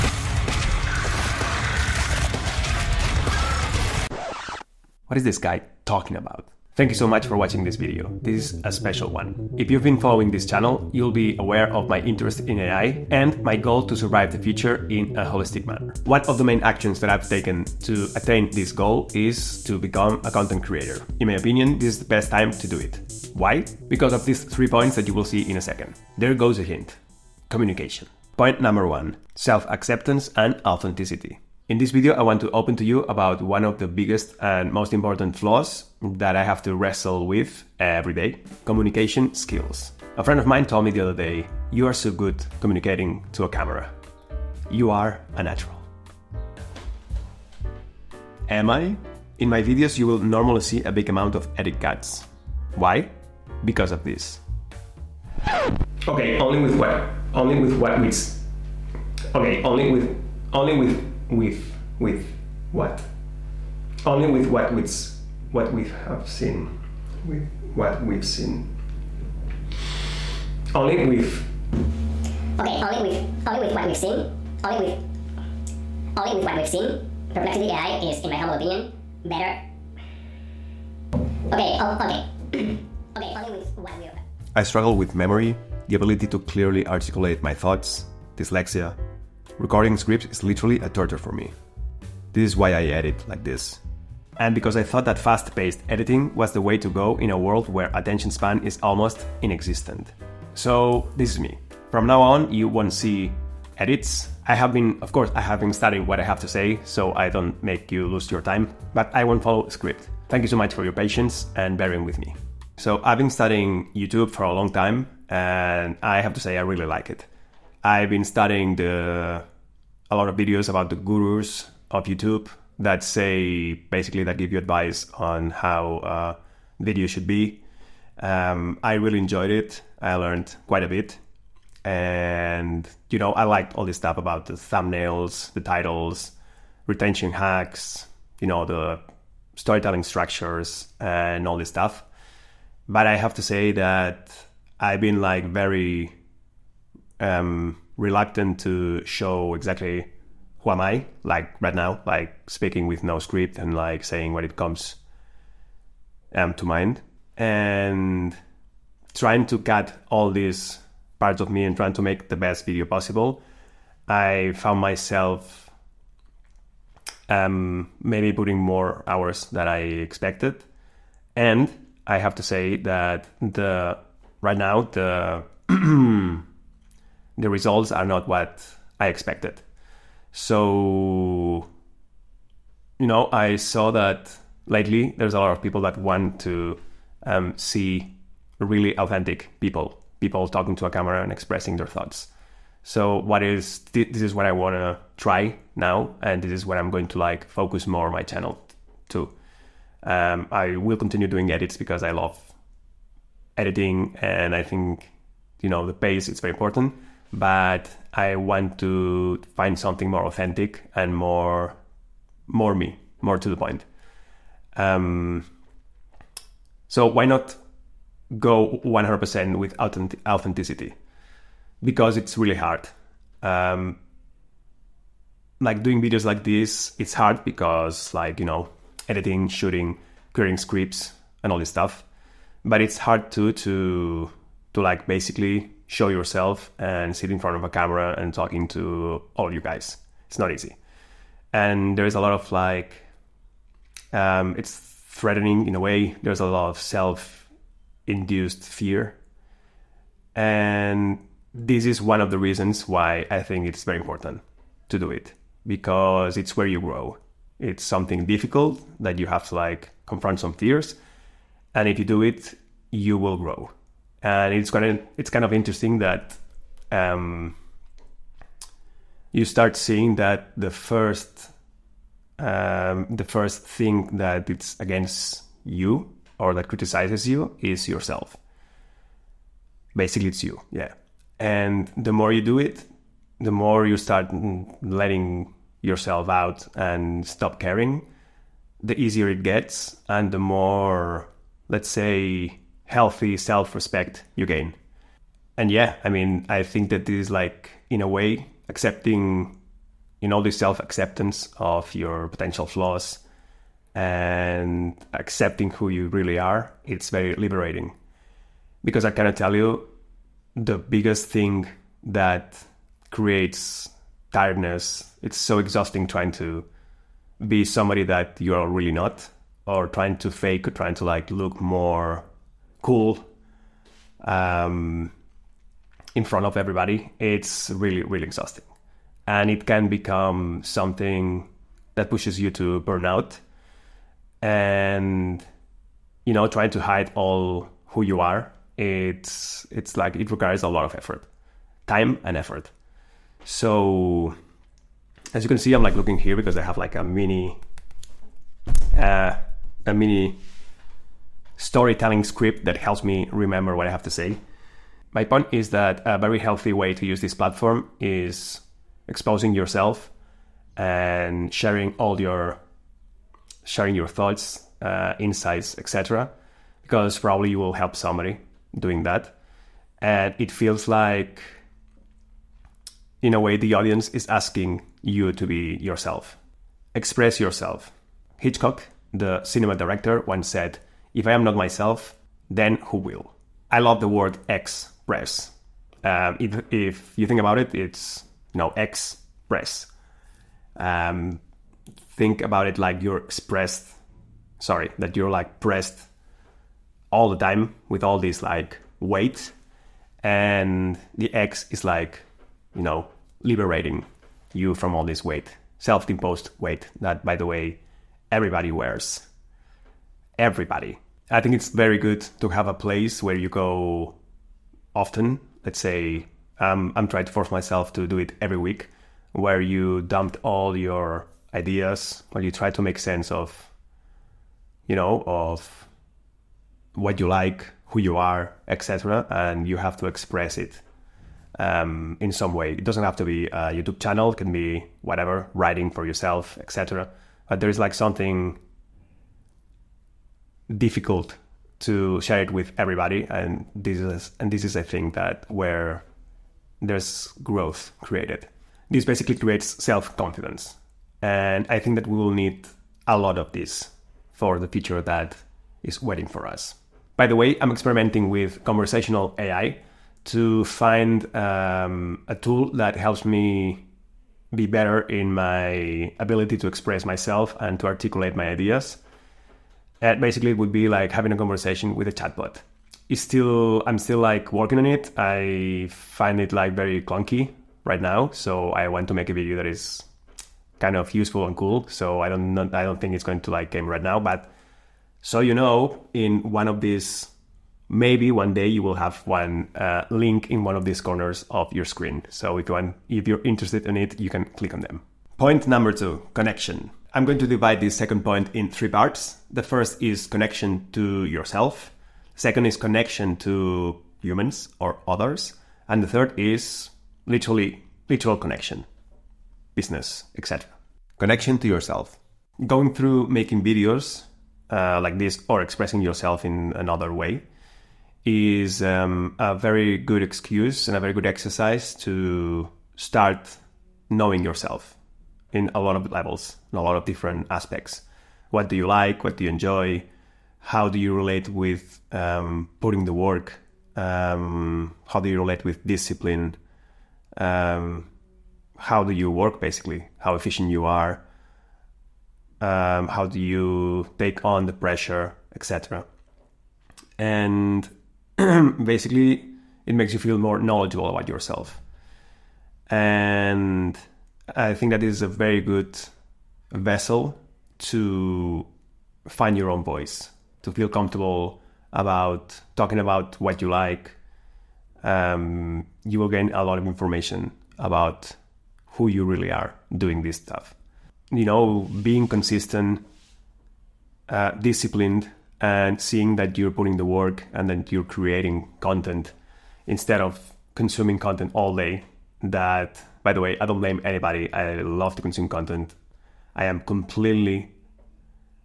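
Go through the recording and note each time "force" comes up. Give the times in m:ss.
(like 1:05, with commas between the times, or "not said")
6:57.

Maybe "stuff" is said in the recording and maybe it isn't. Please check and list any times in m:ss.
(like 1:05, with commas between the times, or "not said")
2:13, 2:21, 3:51, 9:30.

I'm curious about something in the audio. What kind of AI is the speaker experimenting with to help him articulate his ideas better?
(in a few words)
Conversational AI.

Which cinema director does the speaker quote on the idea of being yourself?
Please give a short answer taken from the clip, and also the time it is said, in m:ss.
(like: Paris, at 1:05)
Hitchcock, at 6:18.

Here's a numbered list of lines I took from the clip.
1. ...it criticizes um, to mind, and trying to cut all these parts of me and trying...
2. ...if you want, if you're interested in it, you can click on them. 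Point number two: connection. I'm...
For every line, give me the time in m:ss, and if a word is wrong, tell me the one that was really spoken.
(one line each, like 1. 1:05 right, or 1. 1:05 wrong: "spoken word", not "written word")
1. 2:34 wrong: "comes", not "criticizes"
2. 8:12 right.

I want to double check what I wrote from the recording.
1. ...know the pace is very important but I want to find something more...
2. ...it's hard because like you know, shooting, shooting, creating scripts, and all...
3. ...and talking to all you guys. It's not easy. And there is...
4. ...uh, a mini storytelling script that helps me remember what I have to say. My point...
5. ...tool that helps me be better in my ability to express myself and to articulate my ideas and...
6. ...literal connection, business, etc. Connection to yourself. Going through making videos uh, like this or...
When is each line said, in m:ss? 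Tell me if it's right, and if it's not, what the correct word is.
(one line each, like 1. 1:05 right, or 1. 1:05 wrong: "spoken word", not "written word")
1. 3:25 right
2. 3:46 wrong: "editing", not "shooting"
3. 3:58 right
4. 5:48 right
5. 7:42 right
6. 8:28 right.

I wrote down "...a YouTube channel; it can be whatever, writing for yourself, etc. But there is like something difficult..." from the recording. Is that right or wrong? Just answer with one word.
right.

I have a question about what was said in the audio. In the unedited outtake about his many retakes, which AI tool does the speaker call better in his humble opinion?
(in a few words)
Perplexity AI.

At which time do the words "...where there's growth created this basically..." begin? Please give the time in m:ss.
7:25.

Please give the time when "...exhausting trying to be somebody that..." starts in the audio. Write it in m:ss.
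5:15.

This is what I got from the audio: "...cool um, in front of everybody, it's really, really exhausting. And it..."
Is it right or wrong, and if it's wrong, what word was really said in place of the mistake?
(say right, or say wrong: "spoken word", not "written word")
right.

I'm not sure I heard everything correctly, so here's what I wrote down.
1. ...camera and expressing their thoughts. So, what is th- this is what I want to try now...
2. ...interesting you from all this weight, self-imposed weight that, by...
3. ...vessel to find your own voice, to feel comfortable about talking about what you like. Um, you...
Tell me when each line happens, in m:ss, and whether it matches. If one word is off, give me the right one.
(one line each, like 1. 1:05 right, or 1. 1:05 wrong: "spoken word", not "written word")
1. 3:10 right
2. 6:43 wrong: "liberating", not "interesting"
3. 9:16 right.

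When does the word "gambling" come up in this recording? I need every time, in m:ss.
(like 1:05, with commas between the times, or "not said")
not said.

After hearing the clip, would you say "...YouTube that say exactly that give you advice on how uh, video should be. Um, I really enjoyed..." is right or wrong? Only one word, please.
wrong.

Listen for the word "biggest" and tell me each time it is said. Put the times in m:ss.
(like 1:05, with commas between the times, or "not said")
0:33, 5:10.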